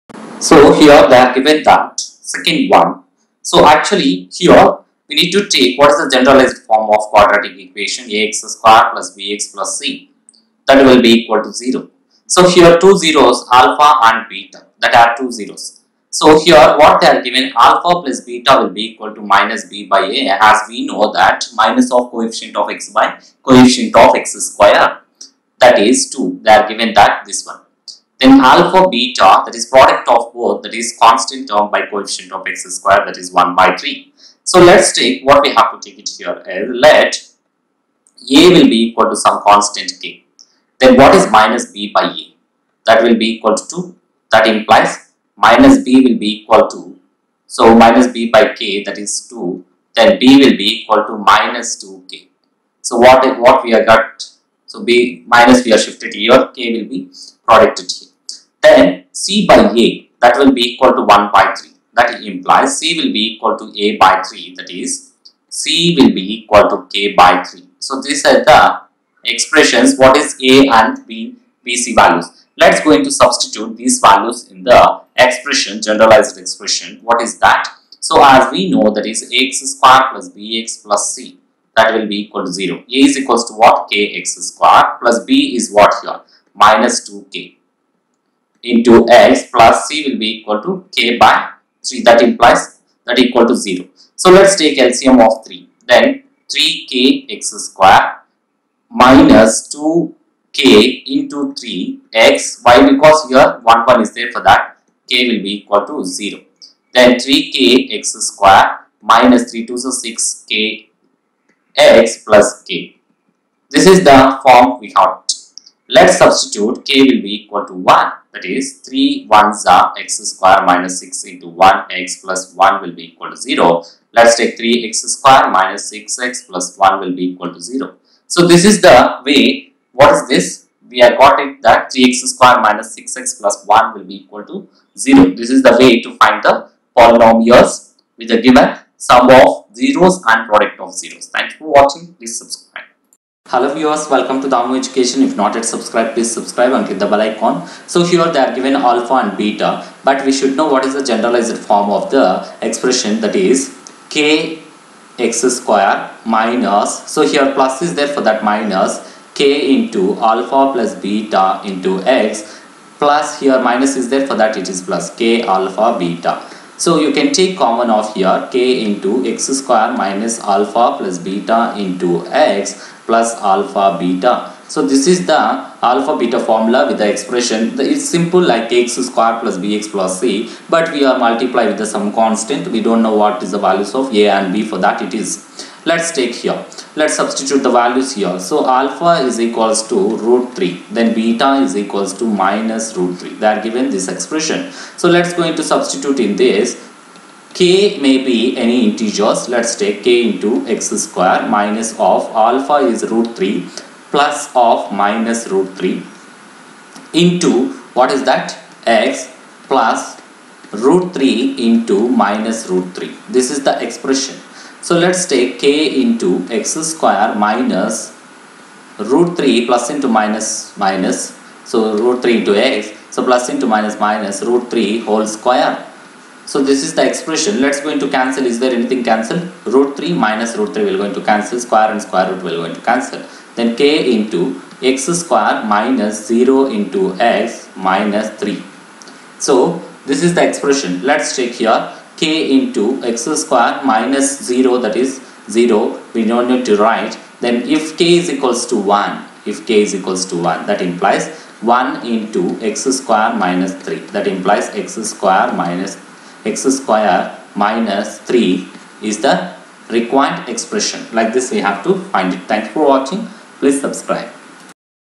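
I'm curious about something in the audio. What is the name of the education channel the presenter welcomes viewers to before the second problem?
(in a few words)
Damu Education.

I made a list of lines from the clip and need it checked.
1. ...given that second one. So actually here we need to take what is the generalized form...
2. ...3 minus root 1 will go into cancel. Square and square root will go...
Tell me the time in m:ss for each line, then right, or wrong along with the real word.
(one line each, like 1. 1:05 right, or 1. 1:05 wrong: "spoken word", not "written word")
1. 0:01 right
2. 3:49 wrong: "3", not "1".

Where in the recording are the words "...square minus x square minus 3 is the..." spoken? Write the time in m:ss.
4:15.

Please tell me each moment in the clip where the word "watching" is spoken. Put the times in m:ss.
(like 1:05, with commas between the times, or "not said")
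2:21, 4:22.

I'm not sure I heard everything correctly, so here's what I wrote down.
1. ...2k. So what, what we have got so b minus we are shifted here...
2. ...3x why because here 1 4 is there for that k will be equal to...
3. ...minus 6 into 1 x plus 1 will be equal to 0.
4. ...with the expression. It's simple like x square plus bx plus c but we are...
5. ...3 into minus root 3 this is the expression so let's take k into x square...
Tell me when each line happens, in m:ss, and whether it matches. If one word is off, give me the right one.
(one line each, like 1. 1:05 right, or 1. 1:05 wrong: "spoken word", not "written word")
1. 0:51 right
2. 1:41 wrong: "1", not "4"
3. 2:00 right
4. 2:56 right
5. 3:31 right.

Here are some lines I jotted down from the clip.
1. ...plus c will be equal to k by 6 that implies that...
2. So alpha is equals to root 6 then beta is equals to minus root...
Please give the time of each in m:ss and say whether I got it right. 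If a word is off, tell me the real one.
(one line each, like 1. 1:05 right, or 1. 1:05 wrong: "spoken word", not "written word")
1. 1:29 wrong: "3", not "6"
2. 3:08 wrong: "3", not "6".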